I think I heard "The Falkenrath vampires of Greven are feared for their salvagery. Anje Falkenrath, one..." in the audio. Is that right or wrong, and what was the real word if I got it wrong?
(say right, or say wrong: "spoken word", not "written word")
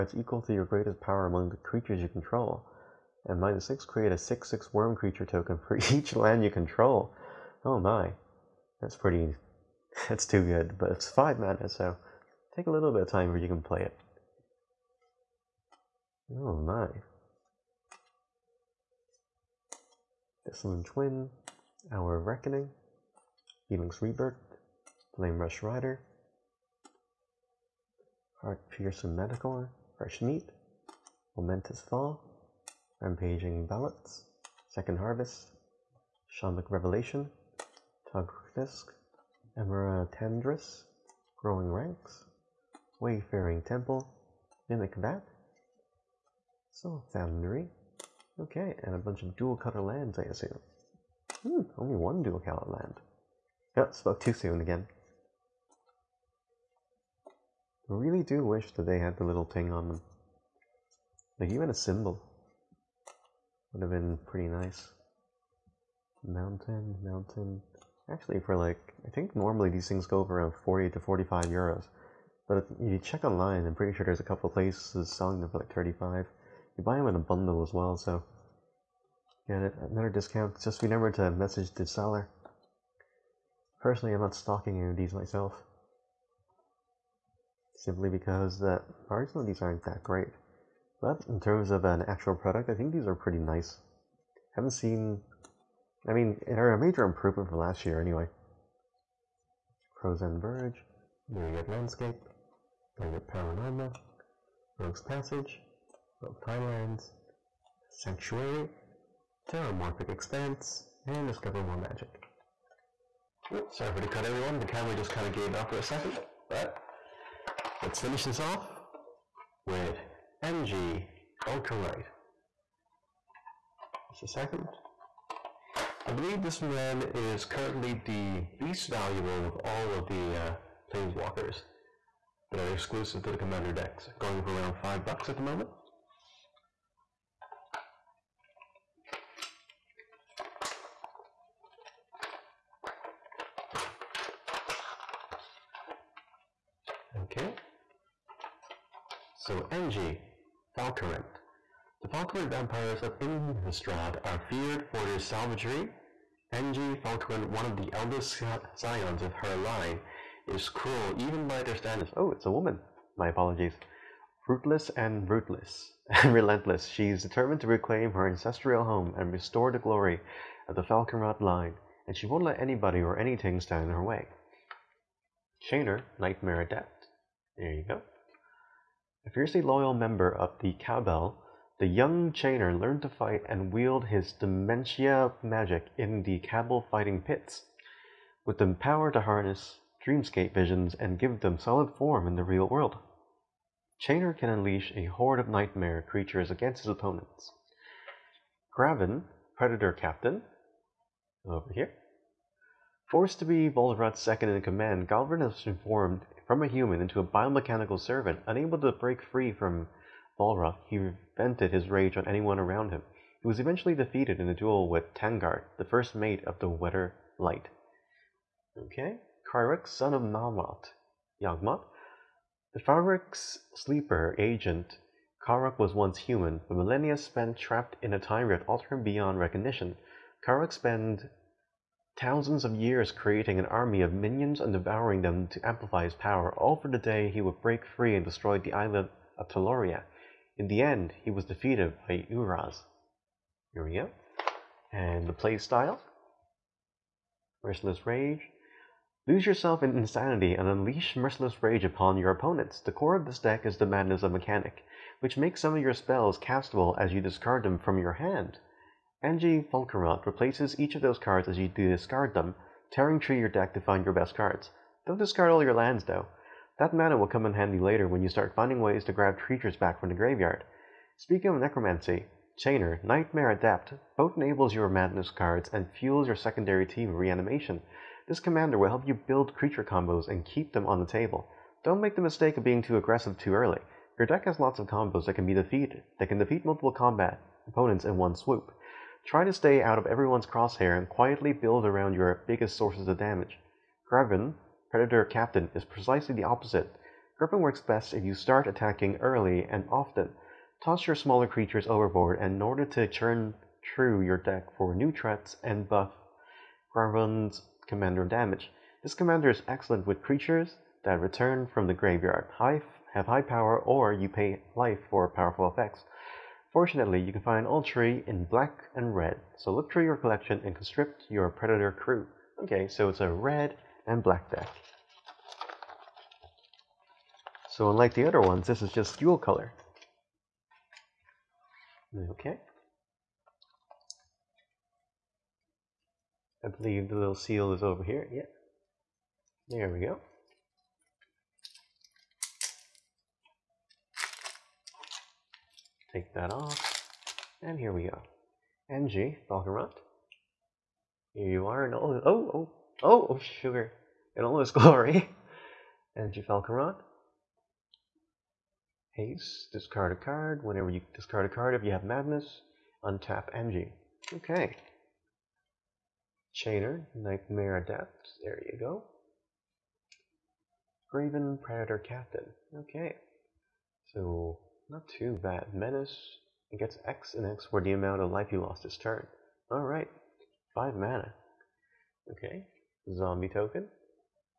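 wrong: "Innistrad", not "Greven".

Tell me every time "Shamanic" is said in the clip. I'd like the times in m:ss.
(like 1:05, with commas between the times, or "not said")
0:36.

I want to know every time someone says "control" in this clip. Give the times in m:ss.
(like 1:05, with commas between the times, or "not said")
0:02, 0:06.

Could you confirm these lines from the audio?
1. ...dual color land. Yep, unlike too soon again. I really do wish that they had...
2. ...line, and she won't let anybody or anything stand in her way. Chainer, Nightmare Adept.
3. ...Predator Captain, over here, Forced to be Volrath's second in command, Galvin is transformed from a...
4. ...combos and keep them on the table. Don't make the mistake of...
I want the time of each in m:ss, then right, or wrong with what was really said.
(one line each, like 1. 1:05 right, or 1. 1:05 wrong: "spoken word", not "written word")
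1. 0:52 wrong: "spoke", not "unlike"
2. 2:51 right
3. 3:19 right
4. 4:39 right.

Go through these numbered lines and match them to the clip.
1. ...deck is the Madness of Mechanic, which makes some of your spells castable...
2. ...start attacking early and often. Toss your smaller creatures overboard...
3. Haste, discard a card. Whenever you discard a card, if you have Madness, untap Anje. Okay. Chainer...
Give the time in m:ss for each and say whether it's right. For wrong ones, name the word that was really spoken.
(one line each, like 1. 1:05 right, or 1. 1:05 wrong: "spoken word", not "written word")
1. 4:13 right
2. 4:58 right
3. 5:59 right.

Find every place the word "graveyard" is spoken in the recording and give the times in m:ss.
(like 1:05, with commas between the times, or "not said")
4:30, 5:11.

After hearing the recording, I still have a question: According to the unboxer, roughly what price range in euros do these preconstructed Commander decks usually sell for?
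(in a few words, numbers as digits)
40 to 45 euros.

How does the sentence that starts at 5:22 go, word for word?
Okay, so it's a red and black deck.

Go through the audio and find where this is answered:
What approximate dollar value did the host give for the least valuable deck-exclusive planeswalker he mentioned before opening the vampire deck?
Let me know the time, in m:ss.
2:14.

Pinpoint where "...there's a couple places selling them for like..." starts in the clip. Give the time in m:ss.
1:14.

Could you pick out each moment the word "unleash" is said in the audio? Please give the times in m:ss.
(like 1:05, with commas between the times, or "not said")
3:14, 4:10.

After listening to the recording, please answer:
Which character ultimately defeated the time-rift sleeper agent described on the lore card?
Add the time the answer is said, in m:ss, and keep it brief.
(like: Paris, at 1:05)
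Urza, at 4:02.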